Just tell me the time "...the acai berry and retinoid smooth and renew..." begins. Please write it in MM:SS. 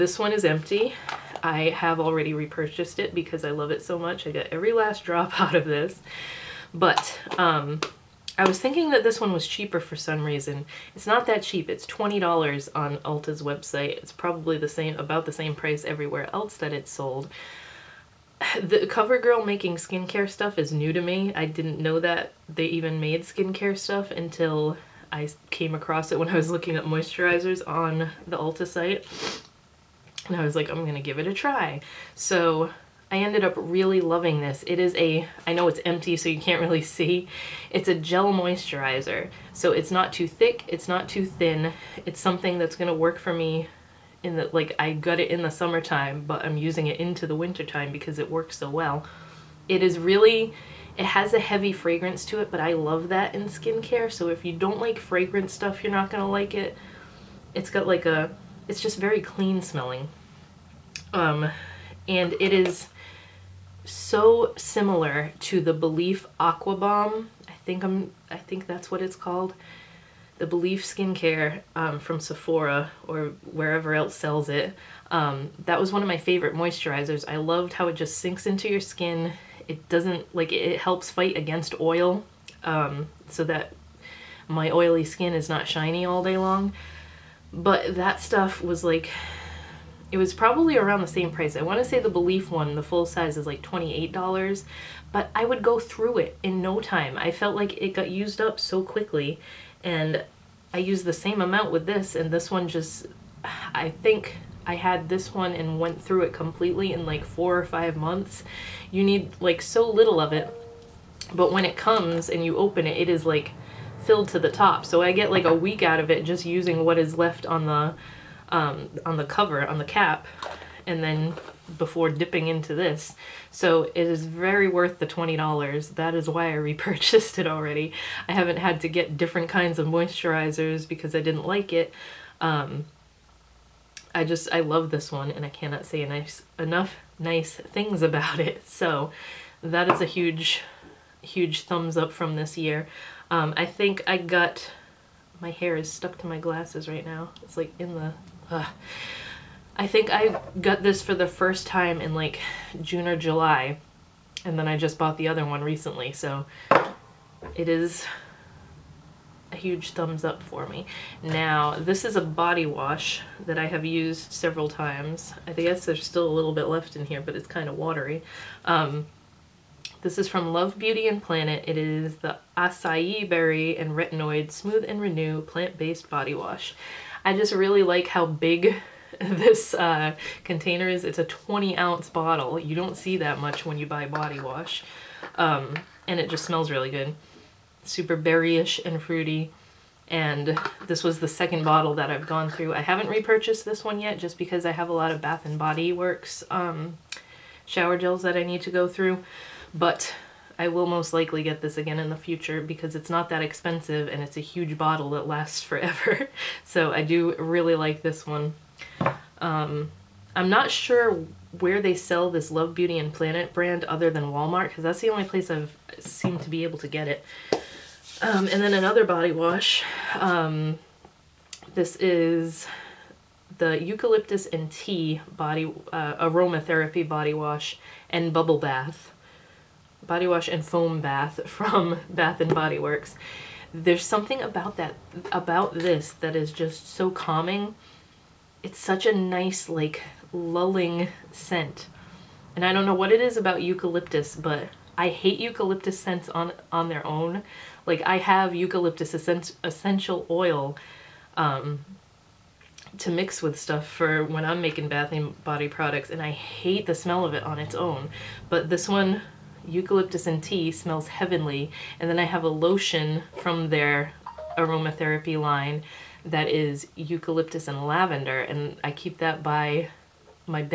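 02:52.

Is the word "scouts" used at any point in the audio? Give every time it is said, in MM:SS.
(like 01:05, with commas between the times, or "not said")
not said.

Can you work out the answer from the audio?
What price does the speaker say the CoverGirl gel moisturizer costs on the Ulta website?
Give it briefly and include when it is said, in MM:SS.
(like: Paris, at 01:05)
$20, at 00:11.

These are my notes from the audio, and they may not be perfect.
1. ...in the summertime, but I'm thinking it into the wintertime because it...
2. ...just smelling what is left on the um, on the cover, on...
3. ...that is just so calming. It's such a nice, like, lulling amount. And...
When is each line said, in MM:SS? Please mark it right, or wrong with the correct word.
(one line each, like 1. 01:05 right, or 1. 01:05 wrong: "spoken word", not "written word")
1. 00:45 wrong: "using", not "thinking"
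2. 01:56 wrong: "using", not "smelling"
3. 03:56 wrong: "scent", not "amount".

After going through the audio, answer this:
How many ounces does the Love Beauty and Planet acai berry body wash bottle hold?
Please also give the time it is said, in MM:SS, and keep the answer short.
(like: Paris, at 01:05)
20 ounces, at 03:01.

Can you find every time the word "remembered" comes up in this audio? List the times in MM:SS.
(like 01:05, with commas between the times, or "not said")
not said.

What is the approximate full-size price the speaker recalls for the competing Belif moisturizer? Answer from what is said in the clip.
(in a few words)
$28.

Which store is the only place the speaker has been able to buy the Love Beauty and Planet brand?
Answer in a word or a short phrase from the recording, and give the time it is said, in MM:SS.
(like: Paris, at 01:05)
Walmart, at 03:34.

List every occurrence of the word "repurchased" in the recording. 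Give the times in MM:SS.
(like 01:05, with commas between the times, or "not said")
00:02, 02:06, 03:13.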